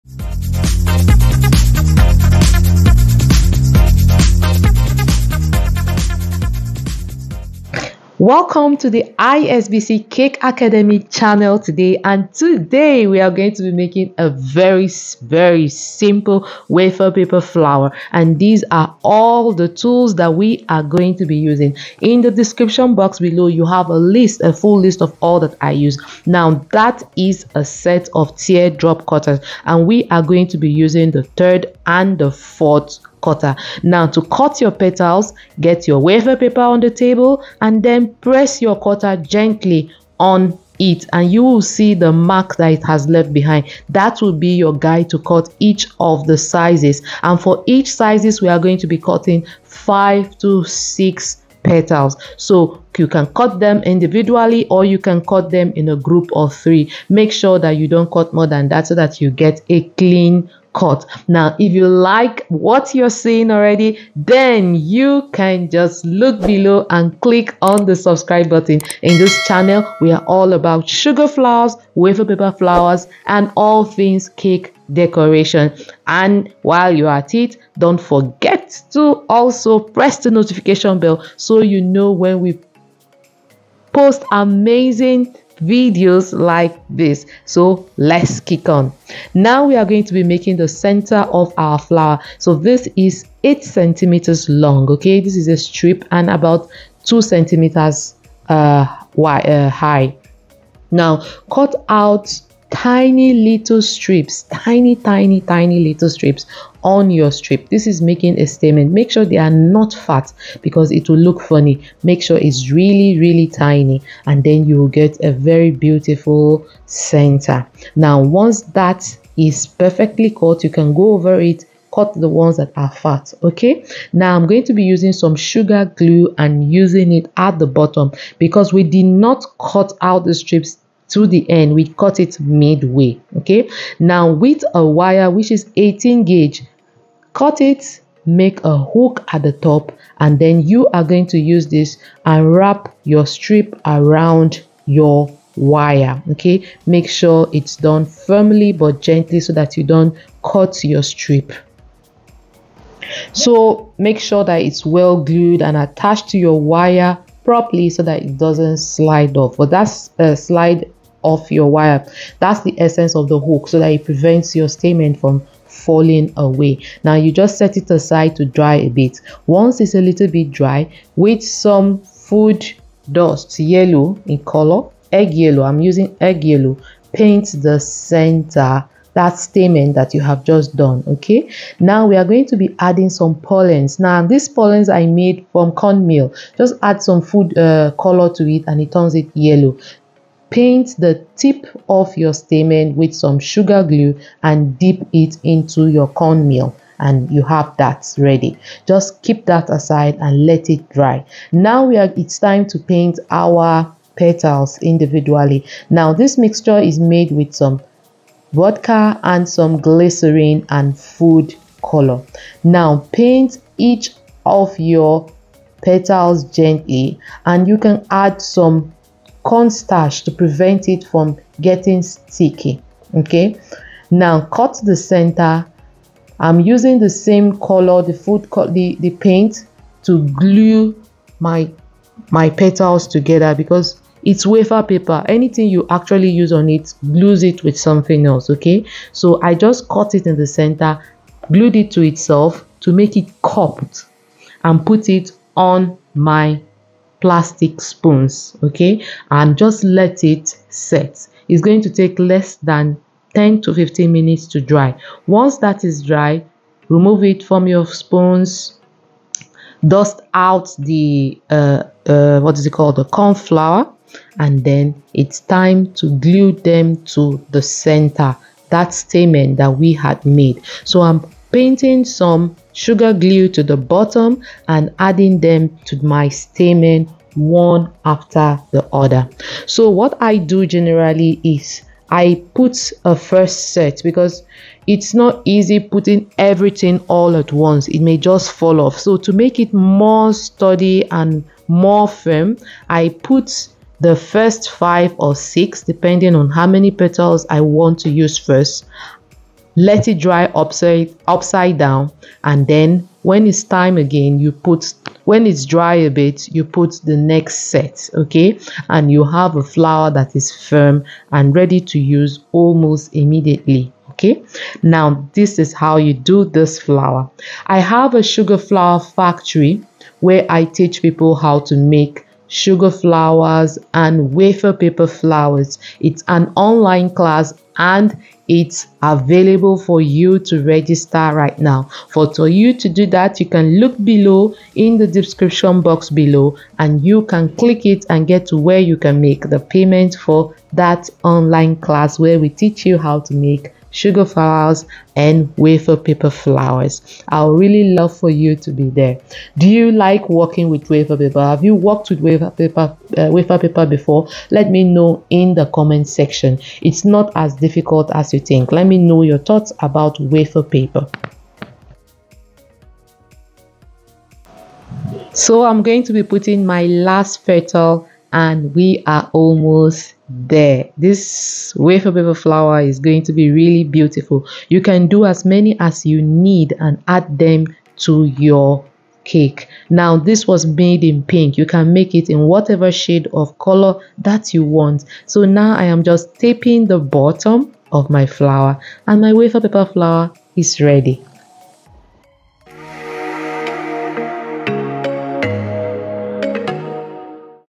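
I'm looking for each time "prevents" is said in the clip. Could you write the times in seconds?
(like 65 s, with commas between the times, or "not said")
164 s, 220 s.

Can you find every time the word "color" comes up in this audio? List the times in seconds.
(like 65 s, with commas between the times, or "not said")
174 s, 187 s, 211 s, 227 s, 383 s.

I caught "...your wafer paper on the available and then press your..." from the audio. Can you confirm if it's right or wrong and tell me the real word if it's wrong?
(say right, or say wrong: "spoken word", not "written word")
wrong: "table", not "available".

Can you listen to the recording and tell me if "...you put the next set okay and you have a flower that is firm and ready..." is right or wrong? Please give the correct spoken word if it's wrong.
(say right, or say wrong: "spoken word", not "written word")
right.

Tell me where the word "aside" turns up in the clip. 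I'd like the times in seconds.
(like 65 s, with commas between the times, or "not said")
167 s, 199 s.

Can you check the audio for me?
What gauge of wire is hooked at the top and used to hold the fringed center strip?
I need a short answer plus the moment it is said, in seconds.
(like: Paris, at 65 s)
18 gauge, at 135 s.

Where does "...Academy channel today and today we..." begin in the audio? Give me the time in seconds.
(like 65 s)
10 s.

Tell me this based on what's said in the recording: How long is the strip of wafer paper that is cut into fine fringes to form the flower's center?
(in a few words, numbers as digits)
8 centimeters.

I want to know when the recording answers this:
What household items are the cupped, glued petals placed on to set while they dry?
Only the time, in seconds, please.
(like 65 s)
247 s.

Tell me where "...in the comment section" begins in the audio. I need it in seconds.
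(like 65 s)
355 s.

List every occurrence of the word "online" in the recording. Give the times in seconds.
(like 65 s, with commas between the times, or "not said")
326 s, 341 s.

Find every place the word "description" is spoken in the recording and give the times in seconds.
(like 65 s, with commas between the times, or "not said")
22 s, 335 s.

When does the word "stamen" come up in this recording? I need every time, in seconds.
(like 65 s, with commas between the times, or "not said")
164 s, 179 s, 192 s, 268 s, 276 s.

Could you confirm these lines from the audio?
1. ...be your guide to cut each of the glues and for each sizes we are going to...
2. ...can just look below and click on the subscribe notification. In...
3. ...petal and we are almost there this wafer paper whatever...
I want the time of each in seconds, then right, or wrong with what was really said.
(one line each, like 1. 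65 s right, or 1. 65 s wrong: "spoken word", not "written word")
1. 44 s wrong: "sizes", not "glues"
2. 65 s wrong: "button", not "notification"
3. 367 s wrong: "flower", not "whatever".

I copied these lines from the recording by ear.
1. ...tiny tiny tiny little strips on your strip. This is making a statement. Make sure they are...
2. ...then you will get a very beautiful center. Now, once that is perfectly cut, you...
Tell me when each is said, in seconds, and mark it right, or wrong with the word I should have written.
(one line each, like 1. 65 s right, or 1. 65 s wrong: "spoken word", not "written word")
1. 104 s right
2. 114 s right.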